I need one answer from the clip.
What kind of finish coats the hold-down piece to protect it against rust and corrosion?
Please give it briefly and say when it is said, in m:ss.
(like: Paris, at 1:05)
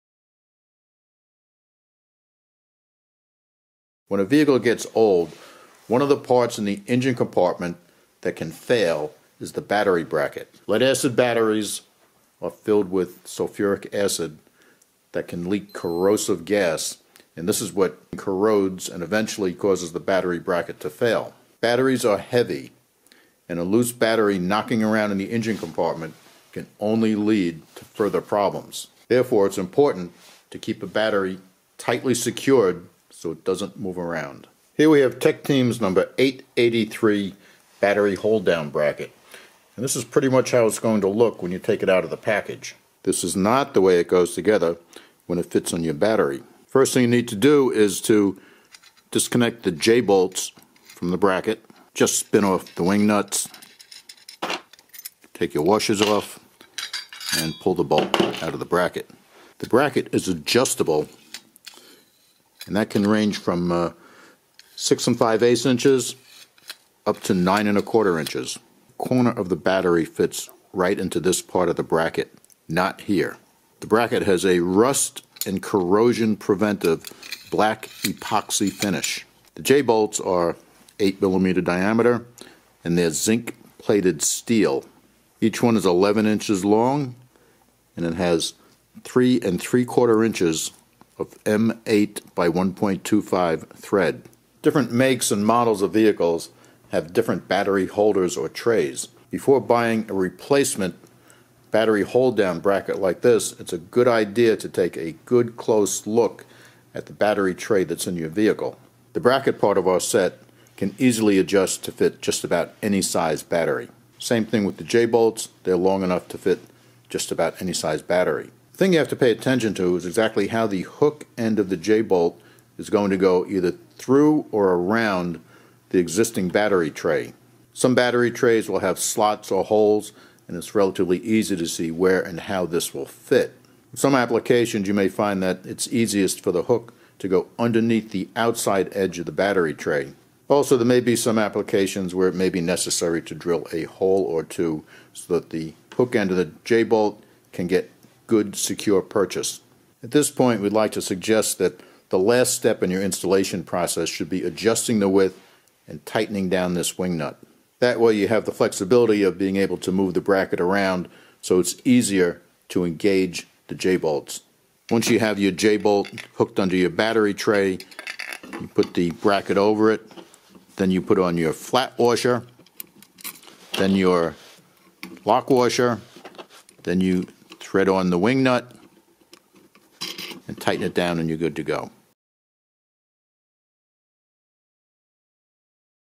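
black epoxy, at 1:17.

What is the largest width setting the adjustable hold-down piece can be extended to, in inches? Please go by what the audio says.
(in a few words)
9 1/4 inches.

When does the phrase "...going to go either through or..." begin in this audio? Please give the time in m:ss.
2:02.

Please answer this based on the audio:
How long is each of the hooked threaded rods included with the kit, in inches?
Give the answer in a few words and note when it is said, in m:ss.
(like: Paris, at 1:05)
11 inches, at 1:25.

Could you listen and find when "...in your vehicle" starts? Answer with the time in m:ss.
1:48.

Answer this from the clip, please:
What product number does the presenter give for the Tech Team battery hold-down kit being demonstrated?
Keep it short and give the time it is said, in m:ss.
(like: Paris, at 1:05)
883, at 0:35.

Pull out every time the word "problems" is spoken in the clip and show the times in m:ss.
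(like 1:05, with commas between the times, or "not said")
0:28.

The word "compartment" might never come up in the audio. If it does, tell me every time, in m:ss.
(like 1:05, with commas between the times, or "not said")
0:07, 0:25.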